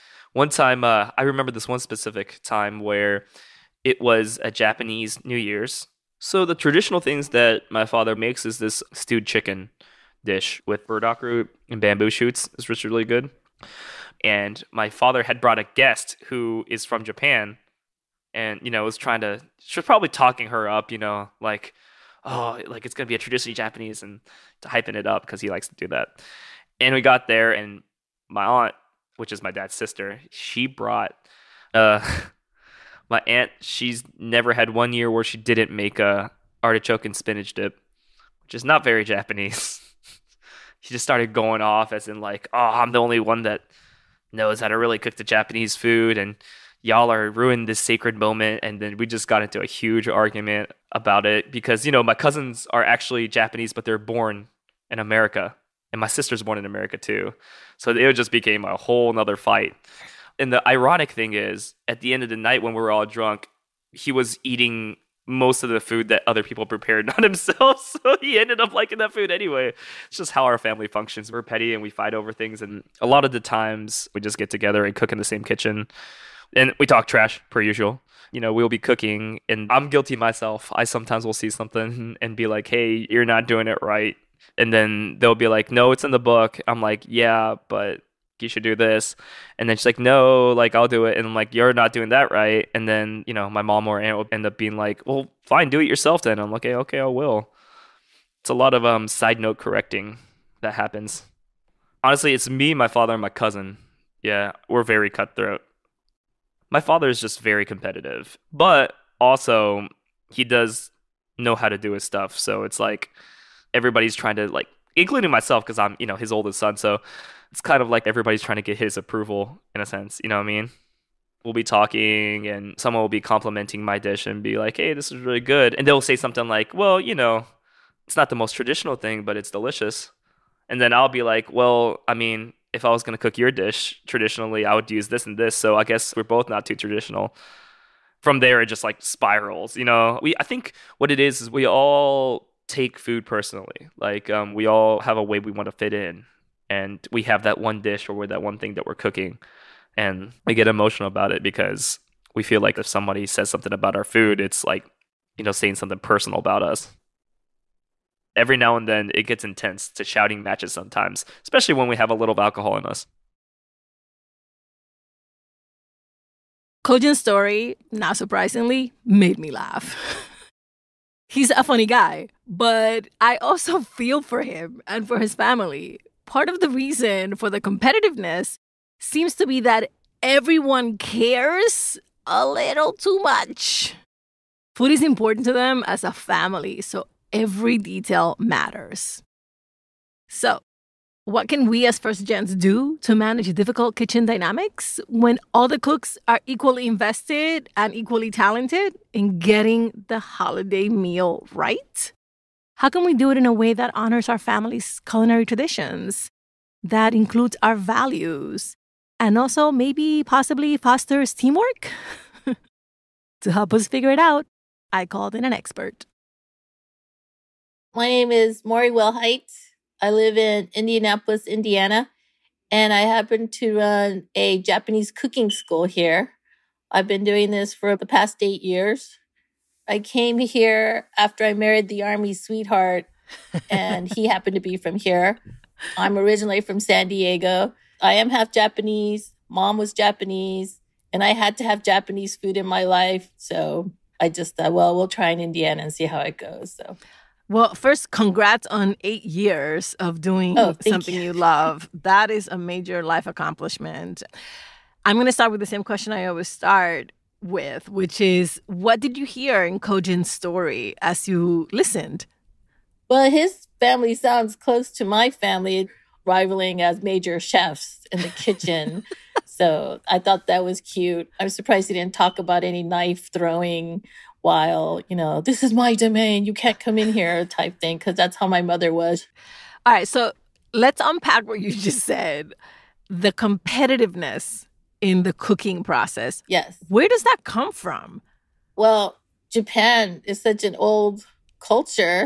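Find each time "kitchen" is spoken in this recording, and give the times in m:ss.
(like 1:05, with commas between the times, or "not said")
1:15, 3:13, 4:28.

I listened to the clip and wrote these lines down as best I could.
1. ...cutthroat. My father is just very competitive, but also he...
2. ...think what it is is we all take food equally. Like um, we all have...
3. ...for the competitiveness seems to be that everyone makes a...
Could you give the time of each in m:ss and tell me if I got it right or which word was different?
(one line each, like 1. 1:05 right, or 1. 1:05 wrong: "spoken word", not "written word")
1. 1:45 right
2. 2:20 wrong: "personally", not "equally"
3. 2:57 wrong: "cares", not "makes".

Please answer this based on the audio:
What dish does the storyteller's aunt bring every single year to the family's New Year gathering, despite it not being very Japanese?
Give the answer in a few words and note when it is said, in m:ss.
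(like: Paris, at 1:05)
artichoke and spinach dip, at 0:36.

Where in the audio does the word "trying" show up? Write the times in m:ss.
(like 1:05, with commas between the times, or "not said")
0:18, 1:54, 1:58.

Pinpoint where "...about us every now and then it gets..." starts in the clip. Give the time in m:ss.
2:36.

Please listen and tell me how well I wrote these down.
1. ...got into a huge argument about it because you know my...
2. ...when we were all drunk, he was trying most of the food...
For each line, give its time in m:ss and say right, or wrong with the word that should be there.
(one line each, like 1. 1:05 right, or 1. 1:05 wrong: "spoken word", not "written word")
1. 0:49 right
2. 1:02 wrong: "eating", not "trying".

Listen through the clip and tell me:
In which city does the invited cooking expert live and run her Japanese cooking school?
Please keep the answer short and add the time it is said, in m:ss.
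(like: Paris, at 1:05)
Indianapolis, at 3:40.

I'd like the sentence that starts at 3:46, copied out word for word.
I've been doing this for the past eight years.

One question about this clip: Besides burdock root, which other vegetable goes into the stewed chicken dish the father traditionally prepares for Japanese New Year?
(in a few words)
bamboo shoots.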